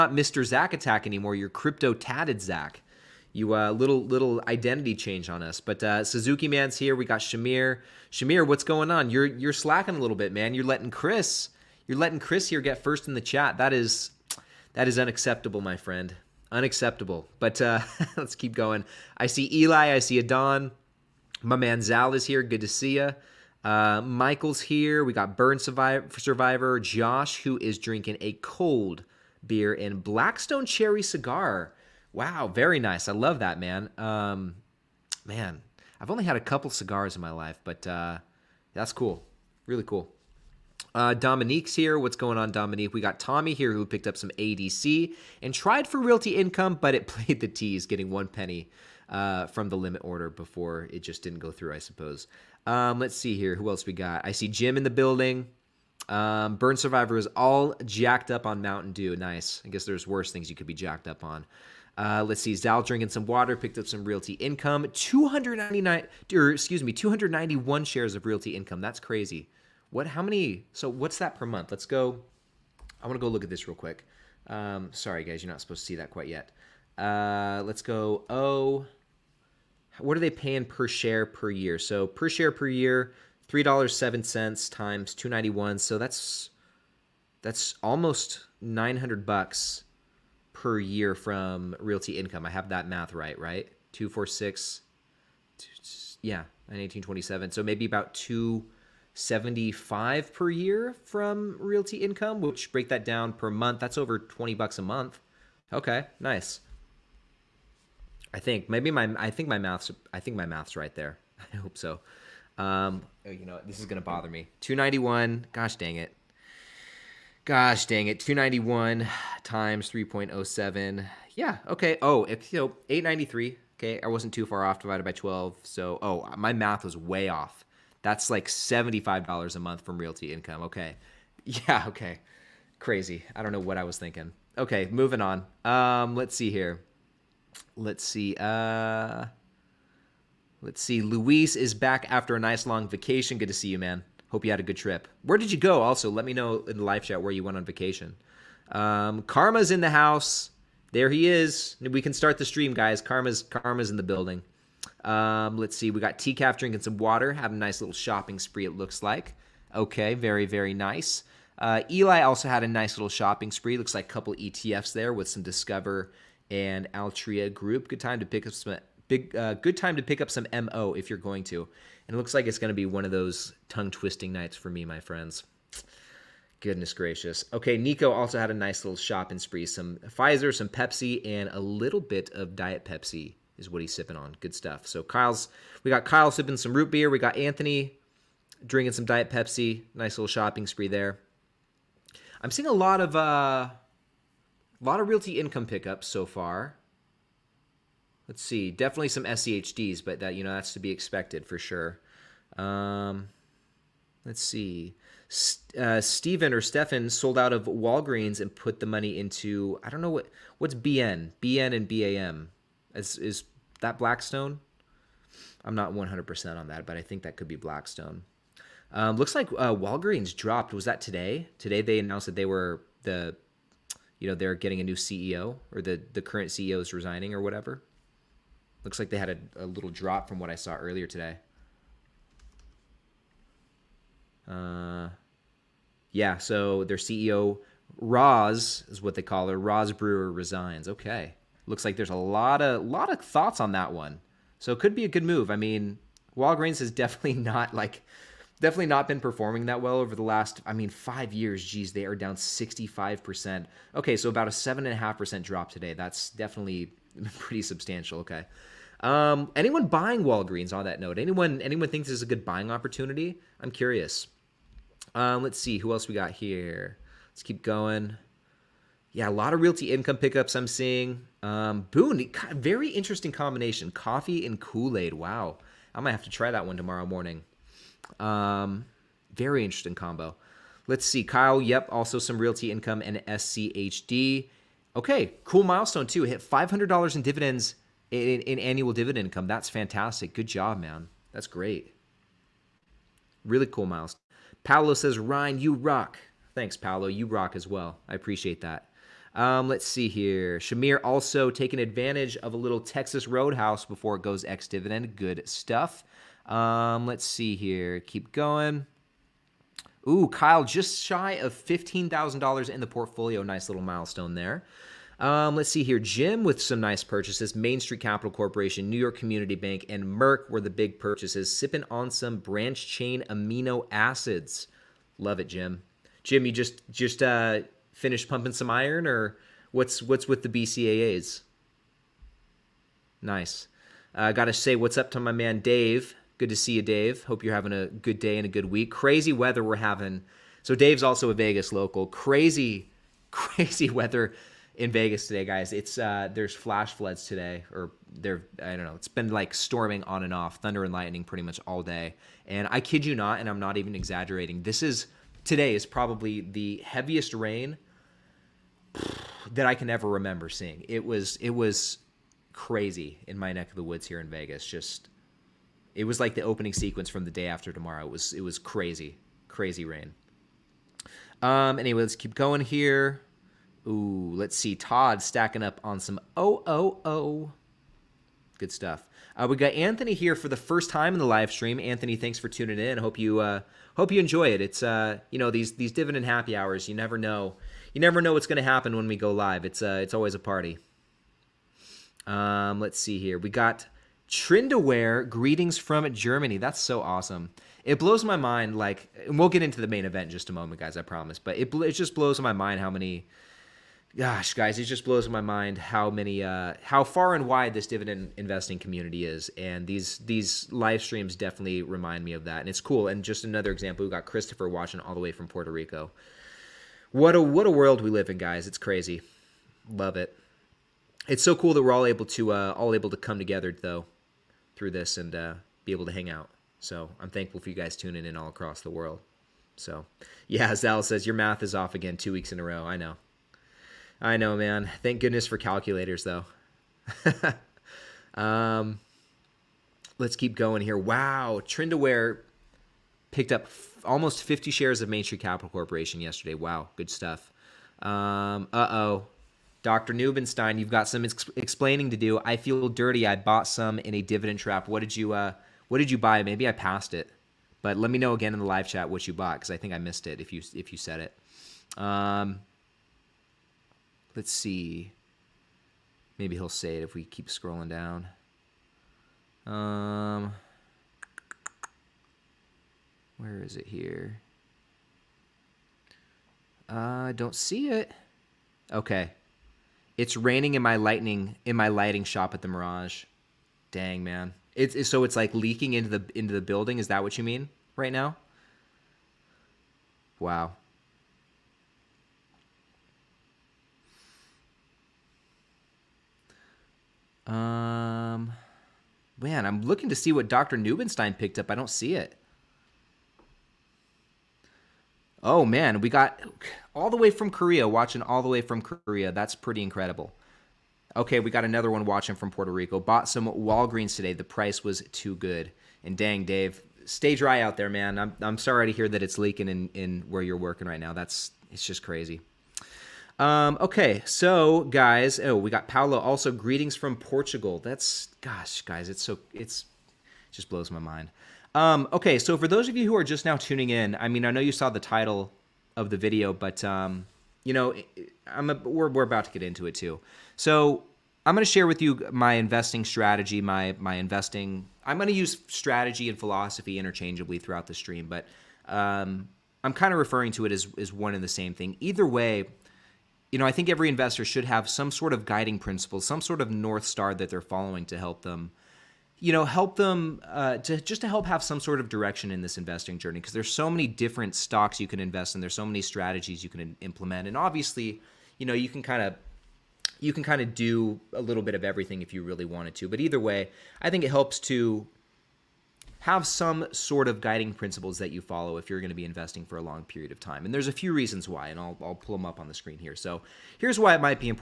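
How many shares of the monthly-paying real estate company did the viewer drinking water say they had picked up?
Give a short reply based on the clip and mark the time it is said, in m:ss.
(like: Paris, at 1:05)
291, at 1:06.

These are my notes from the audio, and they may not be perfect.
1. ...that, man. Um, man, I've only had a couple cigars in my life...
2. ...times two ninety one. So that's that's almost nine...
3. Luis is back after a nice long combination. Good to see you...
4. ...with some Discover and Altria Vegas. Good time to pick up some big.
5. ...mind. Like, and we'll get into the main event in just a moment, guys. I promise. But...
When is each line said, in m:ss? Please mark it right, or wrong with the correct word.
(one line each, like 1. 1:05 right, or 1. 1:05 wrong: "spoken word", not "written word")
1. 0:33 right
2. 1:24 right
3. 2:20 wrong: "vacation", not "combination"
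4. 2:45 wrong: "Group", not "Vegas"
5. 6:38 right.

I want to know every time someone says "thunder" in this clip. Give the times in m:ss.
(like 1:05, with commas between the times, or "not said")
5:50.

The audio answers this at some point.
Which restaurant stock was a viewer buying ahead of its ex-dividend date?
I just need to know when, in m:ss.
5:02.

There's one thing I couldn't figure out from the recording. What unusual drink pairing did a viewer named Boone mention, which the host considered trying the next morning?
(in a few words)
Coffee and Kool Aid.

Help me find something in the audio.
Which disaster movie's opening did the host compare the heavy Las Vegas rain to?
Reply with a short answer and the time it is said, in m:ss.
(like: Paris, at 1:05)
The Day After Tomorrow, at 6:07.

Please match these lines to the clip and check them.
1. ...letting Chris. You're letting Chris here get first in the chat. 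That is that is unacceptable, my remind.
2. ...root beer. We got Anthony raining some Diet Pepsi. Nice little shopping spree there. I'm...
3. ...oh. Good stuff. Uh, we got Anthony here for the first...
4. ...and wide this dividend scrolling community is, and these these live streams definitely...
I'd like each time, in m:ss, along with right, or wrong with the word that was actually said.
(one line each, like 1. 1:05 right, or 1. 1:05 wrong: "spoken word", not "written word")
1. 0:10 wrong: "friend", not "remind"
2. 3:06 wrong: "drinking", not "raining"
3. 6:17 right
4. 6:47 wrong: "investing", not "scrolling".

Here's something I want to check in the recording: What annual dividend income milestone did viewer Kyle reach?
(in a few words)
$500.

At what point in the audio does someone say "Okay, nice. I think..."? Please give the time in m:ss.
1:45.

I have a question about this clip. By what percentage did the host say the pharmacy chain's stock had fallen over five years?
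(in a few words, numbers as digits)
65%.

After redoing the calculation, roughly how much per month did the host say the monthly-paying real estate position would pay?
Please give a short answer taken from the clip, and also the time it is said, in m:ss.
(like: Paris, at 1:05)
$75, at 2:08.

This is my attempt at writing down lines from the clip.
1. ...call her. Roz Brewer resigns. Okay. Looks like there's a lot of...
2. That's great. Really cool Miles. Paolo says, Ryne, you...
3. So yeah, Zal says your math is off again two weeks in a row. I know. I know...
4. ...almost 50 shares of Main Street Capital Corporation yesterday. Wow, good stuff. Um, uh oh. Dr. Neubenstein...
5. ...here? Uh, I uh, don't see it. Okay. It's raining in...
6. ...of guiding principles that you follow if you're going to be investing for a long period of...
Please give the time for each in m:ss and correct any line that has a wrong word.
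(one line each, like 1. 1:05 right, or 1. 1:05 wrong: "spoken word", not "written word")
1. 3:59 right
2. 4:51 right
3. 7:09 right
4. 7:24 right
5. 7:53 right
6. 9:37 right.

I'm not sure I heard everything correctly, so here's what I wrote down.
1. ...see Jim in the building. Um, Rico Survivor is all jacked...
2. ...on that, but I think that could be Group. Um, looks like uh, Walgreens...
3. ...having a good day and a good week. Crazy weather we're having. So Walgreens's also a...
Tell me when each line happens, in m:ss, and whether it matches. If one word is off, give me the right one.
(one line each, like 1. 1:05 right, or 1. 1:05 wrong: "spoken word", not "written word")
1. 0:54 wrong: "Burn", not "Rico"
2. 3:36 wrong: "Blackstone", not "Group"
3. 5:37 wrong: "Dave", not "Walgreens".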